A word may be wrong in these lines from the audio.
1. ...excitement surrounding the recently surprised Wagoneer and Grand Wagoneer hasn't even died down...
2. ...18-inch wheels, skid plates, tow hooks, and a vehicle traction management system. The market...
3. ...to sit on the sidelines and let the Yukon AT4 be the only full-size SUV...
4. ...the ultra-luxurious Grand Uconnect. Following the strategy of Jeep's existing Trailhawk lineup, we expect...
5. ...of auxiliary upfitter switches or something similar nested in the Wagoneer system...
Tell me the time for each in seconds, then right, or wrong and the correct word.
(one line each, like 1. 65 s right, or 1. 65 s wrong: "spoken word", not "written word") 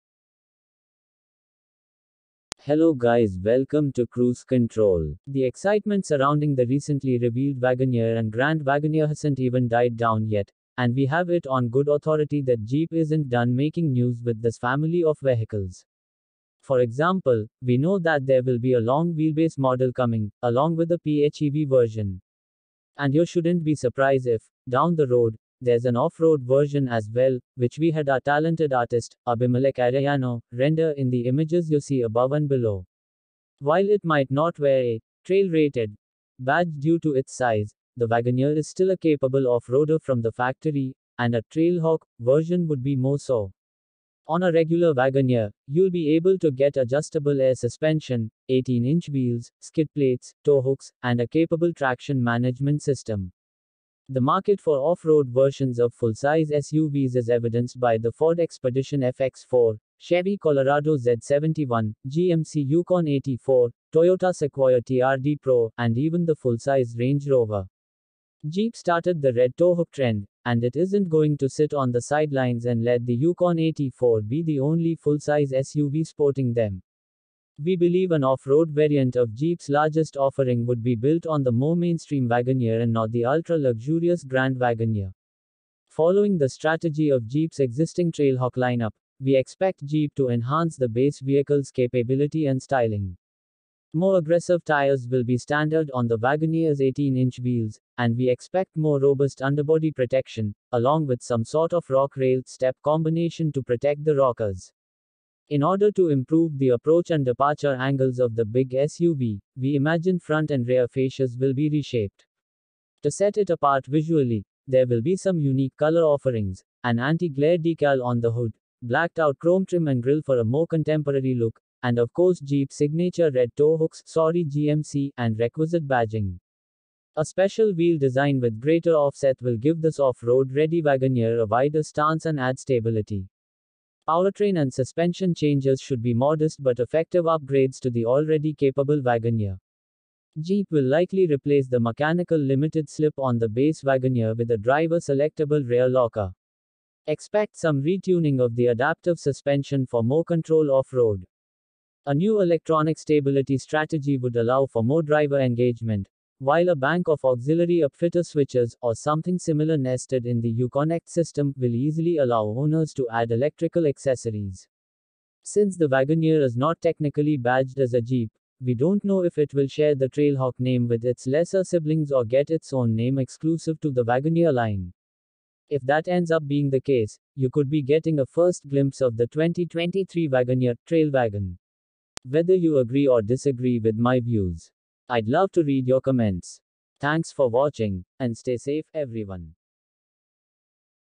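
1. 5 s wrong: "revealed", not "surprised"
2. 48 s wrong: "capable", not "vehicle"
3. 71 s right
4. 83 s wrong: "Wagoneer", not "Uconnect"
5. 157 s wrong: "Uconnect", not "Wagoneer".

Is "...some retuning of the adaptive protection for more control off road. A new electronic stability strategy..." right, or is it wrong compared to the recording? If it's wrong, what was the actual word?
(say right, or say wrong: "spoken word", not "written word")
wrong: "suspension", not "protection".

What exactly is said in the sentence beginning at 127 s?
A special wheel design with greater offset will give this off-road ready Wagoneer a wider stance and add stability.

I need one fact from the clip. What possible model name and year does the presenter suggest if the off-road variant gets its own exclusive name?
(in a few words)
2023 Wagoneer Trail Wagon.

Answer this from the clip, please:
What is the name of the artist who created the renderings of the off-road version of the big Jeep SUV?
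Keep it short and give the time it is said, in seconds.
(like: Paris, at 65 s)
Abimelech Arellano, at 29 s.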